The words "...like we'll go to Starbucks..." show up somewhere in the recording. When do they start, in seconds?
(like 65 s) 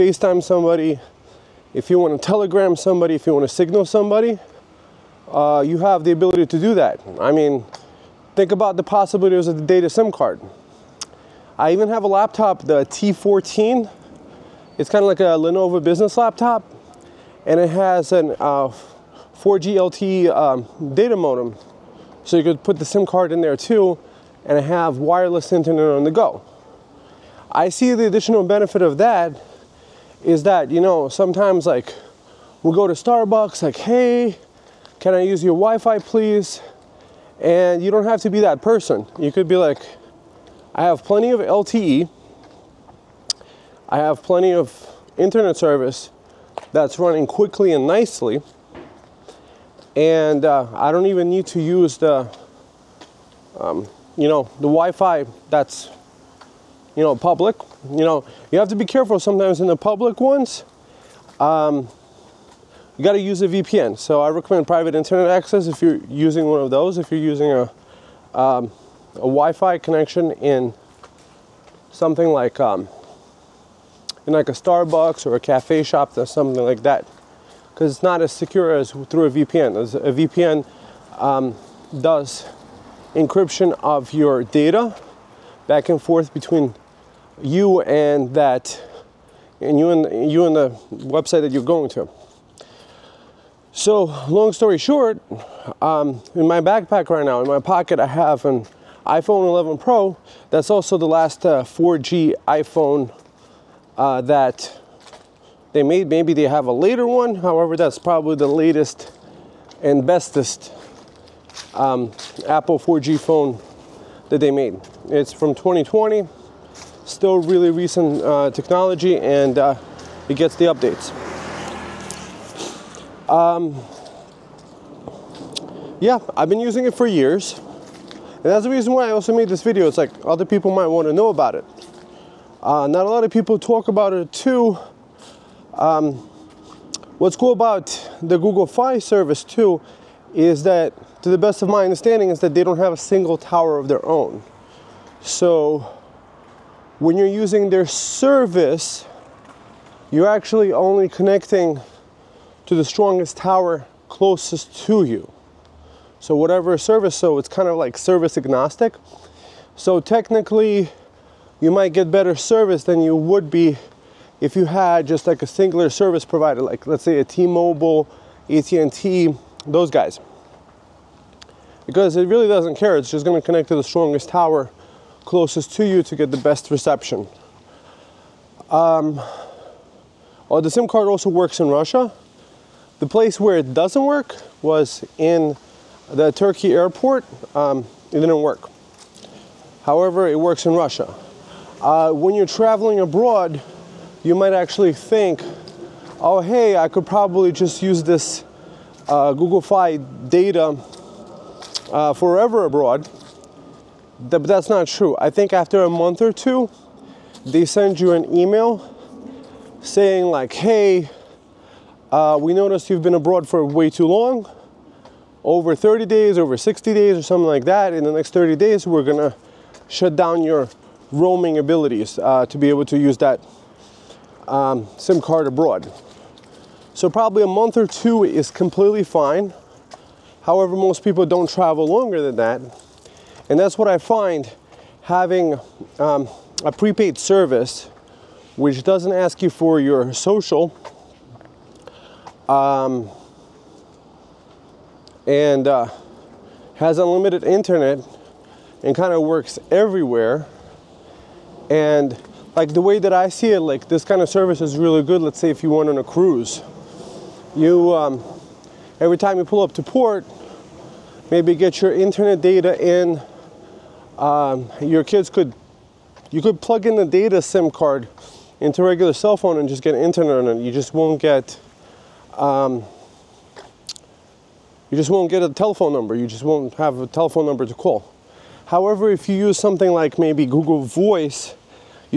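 31 s.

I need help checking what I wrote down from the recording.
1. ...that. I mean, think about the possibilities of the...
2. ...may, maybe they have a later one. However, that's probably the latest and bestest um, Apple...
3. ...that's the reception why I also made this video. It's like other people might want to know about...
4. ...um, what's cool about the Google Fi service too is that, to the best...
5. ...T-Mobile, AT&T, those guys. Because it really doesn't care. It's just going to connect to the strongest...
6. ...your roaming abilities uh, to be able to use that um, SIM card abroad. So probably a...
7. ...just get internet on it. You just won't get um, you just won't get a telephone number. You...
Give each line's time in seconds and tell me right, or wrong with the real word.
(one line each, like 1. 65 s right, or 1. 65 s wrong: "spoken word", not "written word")
1. 6 s right
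2. 105 s right
3. 128 s wrong: "reason", not "reception"
4. 135 s right
5. 167 s right
6. 220 s right
7. 269 s right.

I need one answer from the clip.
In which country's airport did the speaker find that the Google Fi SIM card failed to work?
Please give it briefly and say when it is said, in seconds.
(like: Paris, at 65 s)
Turkey, at 186 s.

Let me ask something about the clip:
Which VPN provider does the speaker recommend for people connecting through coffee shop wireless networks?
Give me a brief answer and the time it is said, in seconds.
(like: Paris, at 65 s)
Private Internet Access, at 64 s.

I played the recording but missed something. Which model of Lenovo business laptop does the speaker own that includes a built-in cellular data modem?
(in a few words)
T14.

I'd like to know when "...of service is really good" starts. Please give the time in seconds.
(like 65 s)
254 s.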